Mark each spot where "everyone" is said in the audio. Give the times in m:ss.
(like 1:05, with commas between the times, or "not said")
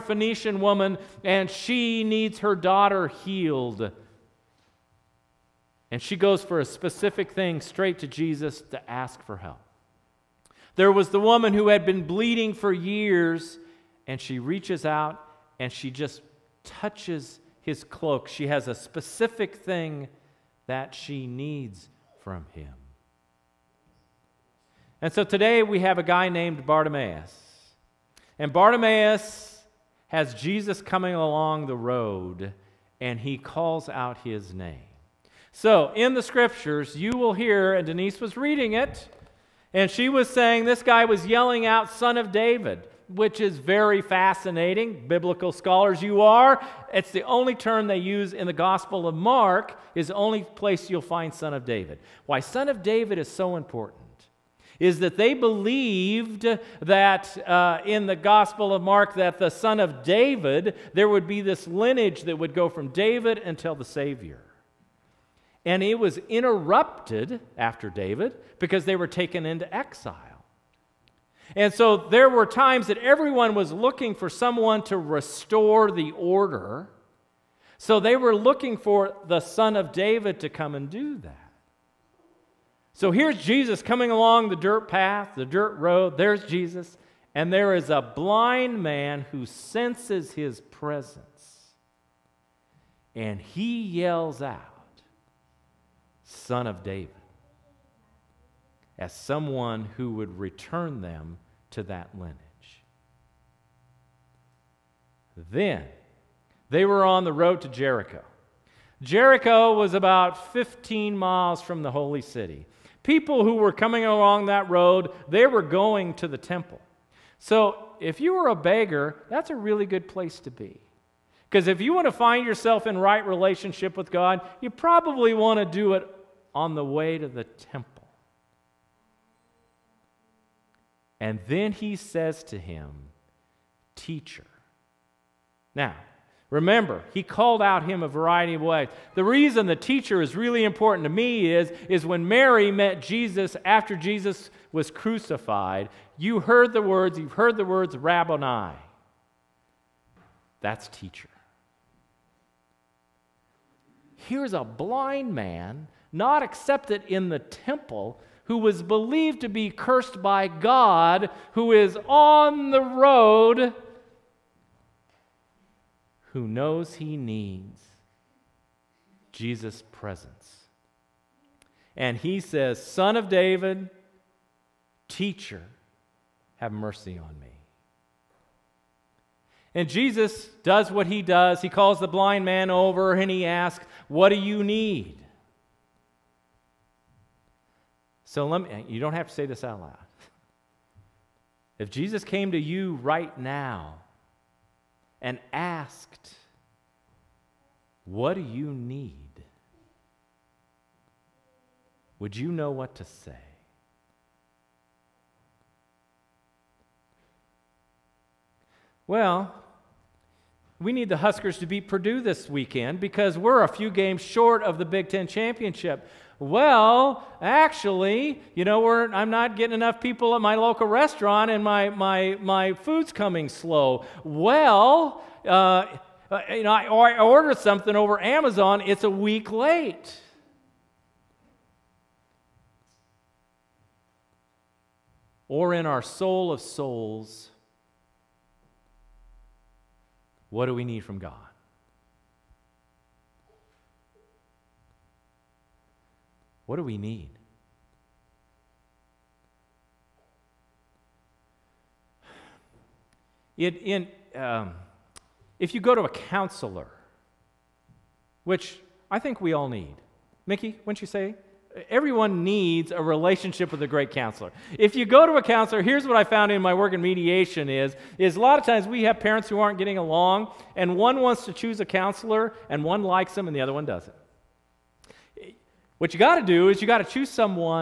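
1:12, 4:21.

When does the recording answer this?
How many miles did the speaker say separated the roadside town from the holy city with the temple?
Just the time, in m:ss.
1:50.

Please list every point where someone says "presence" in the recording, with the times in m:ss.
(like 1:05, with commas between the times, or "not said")
1:30, 2:49.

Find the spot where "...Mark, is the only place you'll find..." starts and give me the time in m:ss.
0:49.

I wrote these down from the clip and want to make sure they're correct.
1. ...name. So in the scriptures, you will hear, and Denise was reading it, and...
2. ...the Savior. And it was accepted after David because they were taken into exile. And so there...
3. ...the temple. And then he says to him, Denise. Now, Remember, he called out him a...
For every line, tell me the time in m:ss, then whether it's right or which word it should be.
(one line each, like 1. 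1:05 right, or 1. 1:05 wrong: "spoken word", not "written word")
1. 0:34 right
2. 1:03 wrong: "interrupted", not "accepted"
3. 2:07 wrong: "Teacher", not "Denise".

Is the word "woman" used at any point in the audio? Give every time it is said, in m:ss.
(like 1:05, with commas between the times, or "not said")
0:00, 0:11.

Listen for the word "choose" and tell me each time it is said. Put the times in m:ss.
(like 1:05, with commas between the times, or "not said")
4:31, 4:37.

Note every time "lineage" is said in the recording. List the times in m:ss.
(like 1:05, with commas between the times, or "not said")
1:01, 1:42.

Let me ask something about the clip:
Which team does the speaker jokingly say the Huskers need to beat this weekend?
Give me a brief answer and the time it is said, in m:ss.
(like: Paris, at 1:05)
Purdue, at 3:31.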